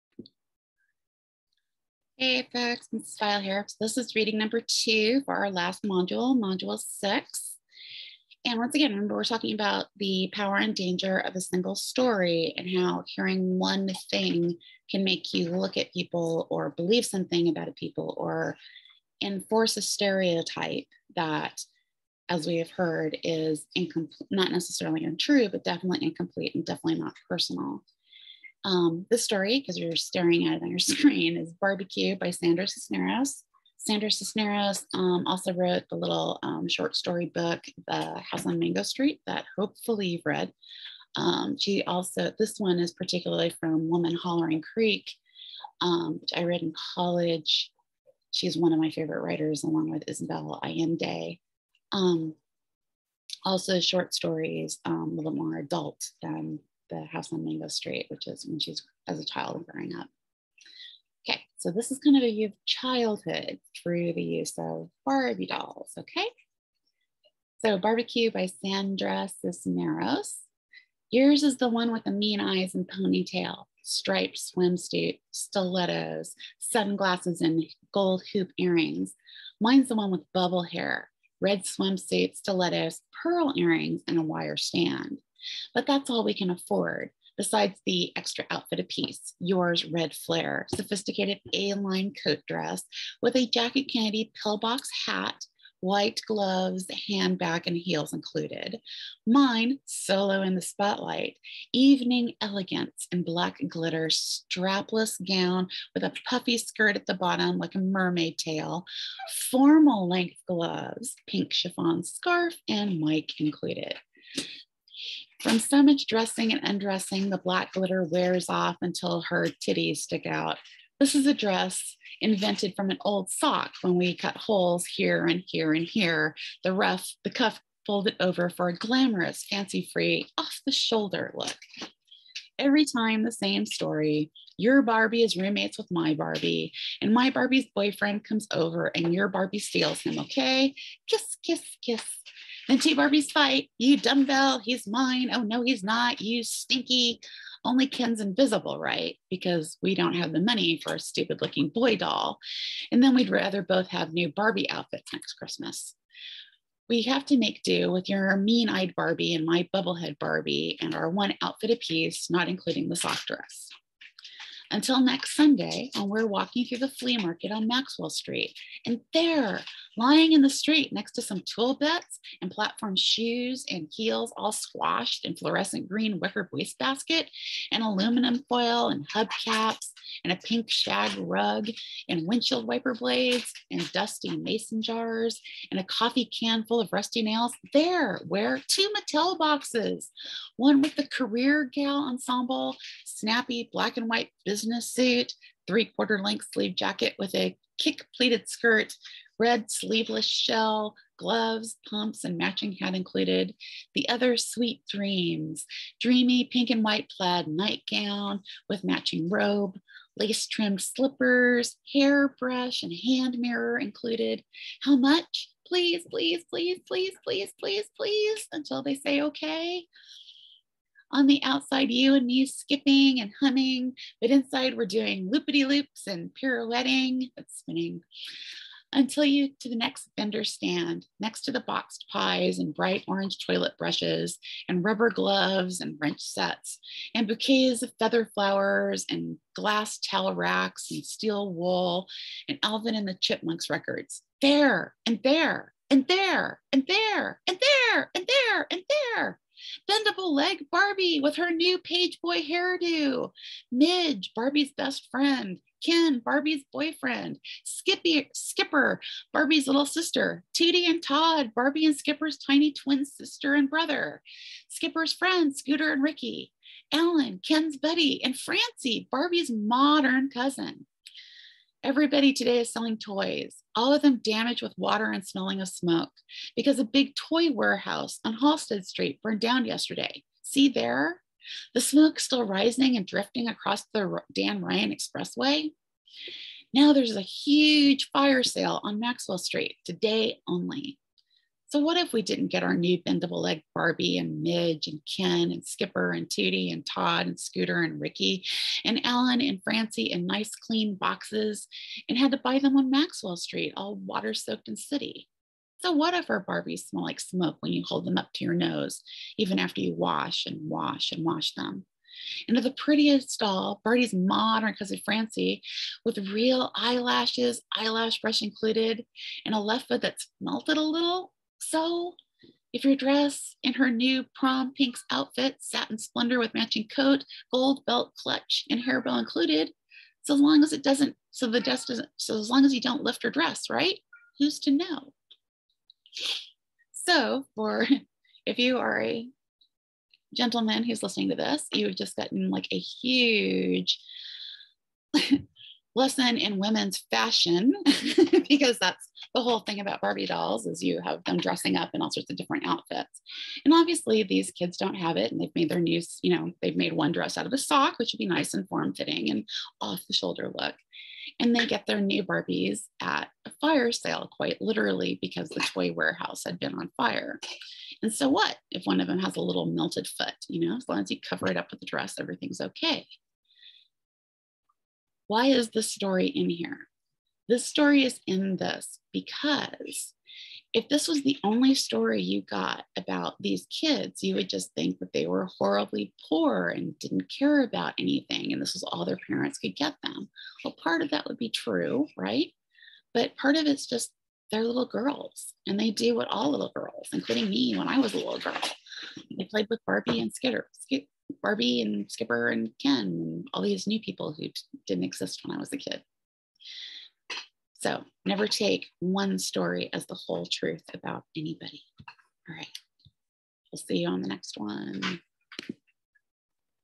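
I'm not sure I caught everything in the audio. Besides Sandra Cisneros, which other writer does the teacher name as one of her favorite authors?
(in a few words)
Isabel Allende.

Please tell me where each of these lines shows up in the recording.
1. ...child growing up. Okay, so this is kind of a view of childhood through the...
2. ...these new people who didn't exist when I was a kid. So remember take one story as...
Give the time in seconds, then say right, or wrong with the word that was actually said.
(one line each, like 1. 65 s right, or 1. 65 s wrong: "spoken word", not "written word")
1. 59 s right
2. 403 s wrong: "never", not "remember".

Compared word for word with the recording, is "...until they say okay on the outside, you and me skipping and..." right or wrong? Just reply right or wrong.
right.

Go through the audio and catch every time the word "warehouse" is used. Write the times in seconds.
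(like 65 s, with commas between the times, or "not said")
277 s, 365 s.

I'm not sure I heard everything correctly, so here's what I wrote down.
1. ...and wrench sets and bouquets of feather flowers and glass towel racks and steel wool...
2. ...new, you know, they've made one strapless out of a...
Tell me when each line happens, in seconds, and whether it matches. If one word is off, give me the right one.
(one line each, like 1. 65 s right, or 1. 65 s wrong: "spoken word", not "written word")
1. 235 s right
2. 355 s wrong: "dress", not "strapless".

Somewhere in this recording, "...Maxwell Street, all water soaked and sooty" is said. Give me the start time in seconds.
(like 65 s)
302 s.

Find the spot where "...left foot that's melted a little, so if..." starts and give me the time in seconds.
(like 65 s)
319 s.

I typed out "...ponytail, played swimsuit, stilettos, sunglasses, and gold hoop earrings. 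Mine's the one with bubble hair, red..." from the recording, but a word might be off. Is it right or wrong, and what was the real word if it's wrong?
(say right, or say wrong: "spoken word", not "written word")
wrong: "striped", not "played".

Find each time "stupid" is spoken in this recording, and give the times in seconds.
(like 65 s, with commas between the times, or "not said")
150 s.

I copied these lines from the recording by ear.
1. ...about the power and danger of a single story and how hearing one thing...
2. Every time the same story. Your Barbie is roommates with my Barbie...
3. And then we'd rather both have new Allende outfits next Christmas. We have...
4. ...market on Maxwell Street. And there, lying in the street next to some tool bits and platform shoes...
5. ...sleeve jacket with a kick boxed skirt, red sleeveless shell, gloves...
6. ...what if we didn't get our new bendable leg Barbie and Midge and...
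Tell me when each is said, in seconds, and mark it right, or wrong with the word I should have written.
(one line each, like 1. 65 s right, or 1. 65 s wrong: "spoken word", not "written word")
1. 9 s right
2. 132 s right
3. 152 s wrong: "Barbie", not "Allende"
4. 167 s right
5. 196 s wrong: "pleated", not "boxed"
6. 291 s right.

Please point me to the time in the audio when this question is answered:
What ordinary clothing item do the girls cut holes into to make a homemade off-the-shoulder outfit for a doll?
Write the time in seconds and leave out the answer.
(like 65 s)
122 s.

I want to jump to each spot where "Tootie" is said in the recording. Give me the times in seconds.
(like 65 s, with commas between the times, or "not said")
260 s, 296 s.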